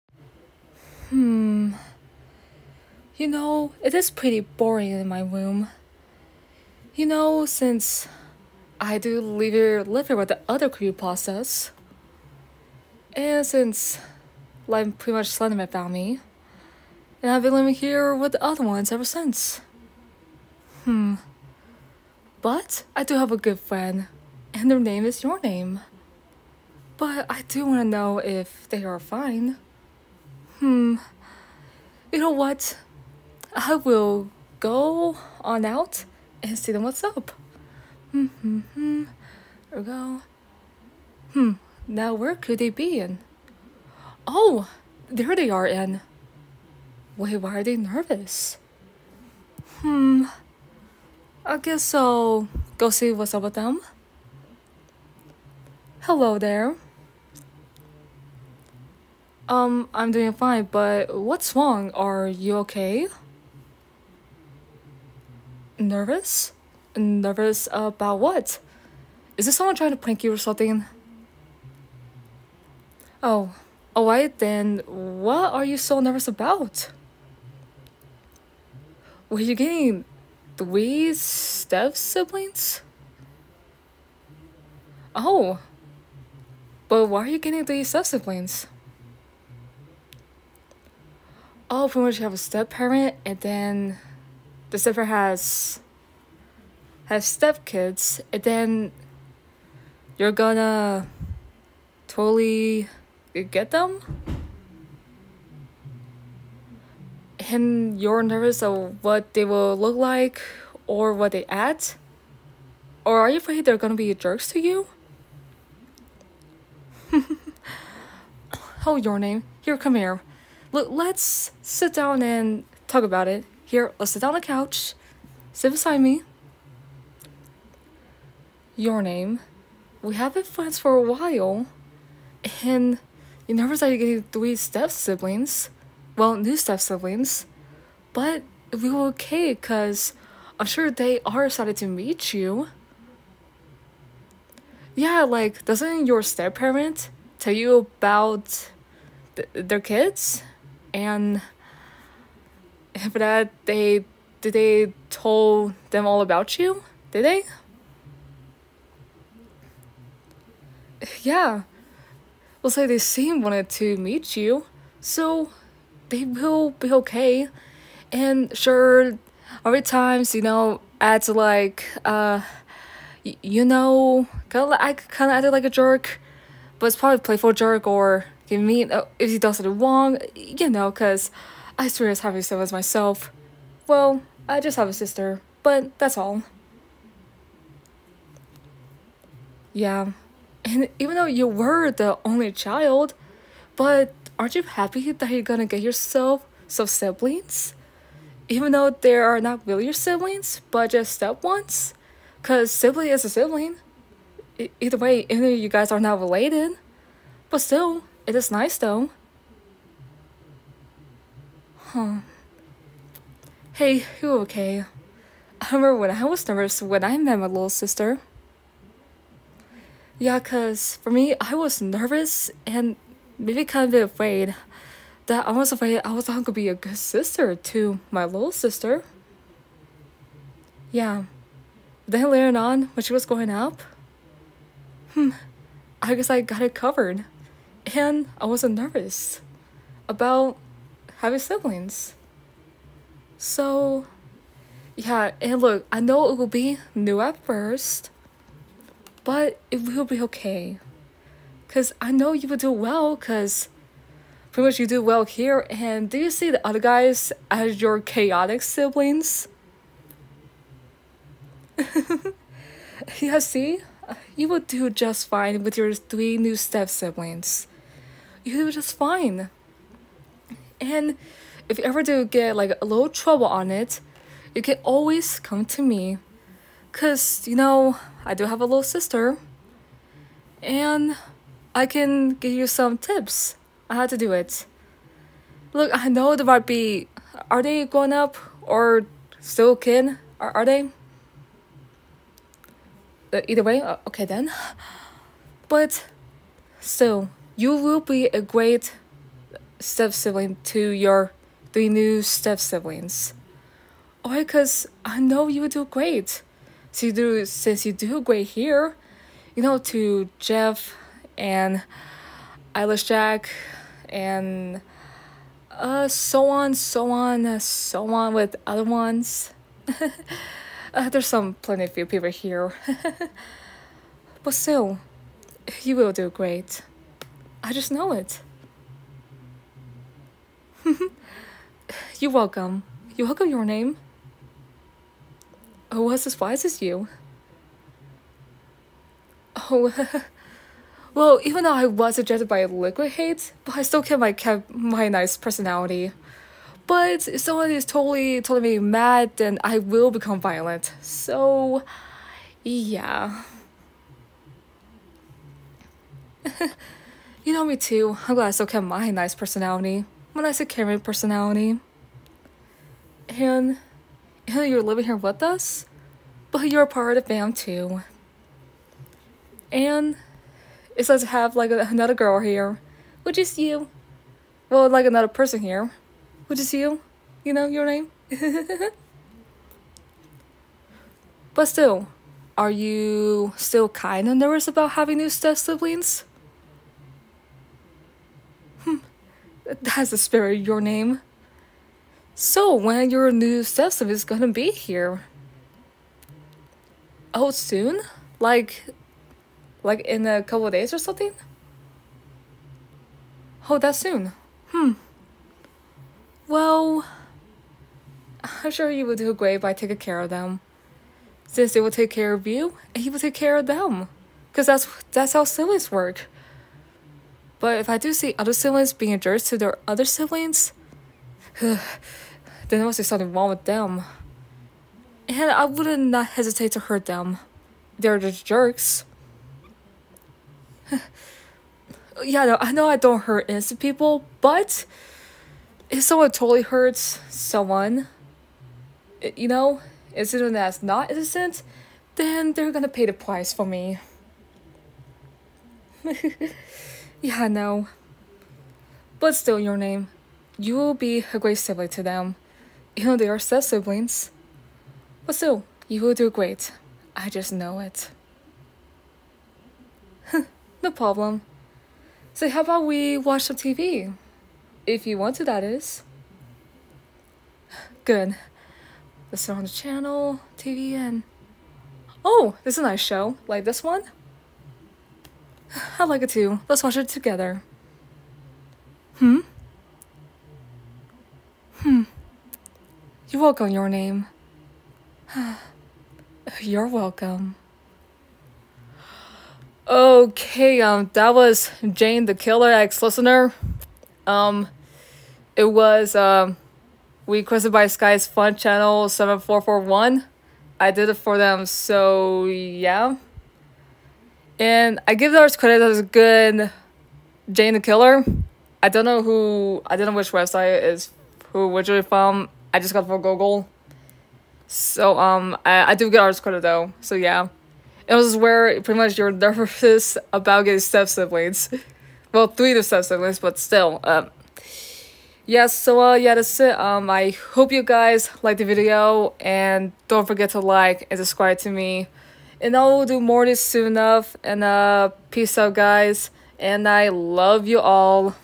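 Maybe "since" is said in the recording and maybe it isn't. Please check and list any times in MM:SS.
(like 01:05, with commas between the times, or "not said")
00:07, 00:13, 00:19, 05:07, 06:51.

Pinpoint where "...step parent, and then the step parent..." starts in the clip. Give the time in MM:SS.
01:32.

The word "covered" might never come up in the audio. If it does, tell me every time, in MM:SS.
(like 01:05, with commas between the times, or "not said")
03:56.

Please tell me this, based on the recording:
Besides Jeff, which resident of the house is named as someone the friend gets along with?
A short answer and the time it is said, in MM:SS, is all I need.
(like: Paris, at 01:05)
Eyeless Jack, at 05:12.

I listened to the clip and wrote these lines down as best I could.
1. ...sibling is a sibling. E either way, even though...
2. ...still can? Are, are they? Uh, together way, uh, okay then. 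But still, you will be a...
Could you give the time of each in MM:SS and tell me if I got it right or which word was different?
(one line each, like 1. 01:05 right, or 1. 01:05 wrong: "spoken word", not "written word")
1. 03:22 right
2. 04:49 wrong: "either", not "together".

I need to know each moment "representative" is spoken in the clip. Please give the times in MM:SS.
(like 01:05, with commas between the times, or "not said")
not said.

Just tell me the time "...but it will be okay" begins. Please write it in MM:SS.
04:09.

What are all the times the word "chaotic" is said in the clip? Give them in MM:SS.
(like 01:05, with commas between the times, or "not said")
04:17.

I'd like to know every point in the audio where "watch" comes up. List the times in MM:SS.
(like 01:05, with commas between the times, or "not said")
07:43, 07:56.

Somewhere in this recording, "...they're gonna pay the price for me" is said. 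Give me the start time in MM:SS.
07:22.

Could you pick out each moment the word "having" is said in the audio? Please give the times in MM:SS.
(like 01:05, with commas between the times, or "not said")
04:01, 06:24.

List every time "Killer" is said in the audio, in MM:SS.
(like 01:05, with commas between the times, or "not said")
08:12, 08:27.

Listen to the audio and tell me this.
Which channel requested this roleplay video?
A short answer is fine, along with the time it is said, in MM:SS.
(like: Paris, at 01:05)
Sky's Fun Channel 7441, at 08:17.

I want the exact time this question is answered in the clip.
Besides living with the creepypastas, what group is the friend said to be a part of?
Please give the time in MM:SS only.
06:07.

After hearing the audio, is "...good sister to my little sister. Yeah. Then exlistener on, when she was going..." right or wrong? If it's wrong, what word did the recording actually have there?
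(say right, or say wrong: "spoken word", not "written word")
wrong: "later", not "exlistener".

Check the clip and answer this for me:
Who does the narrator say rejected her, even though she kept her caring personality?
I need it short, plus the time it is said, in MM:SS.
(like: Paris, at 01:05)
Liquid Hate, at 05:42.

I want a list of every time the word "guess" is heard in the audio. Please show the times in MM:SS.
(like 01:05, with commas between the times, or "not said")
00:51, 03:56.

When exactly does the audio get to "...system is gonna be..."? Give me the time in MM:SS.
06:33.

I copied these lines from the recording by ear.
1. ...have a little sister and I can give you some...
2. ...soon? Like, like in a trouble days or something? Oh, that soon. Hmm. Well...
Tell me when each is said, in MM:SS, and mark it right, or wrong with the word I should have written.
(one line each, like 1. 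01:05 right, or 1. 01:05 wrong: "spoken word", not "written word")
1. 04:38 right
2. 06:37 wrong: "couple", not "trouble".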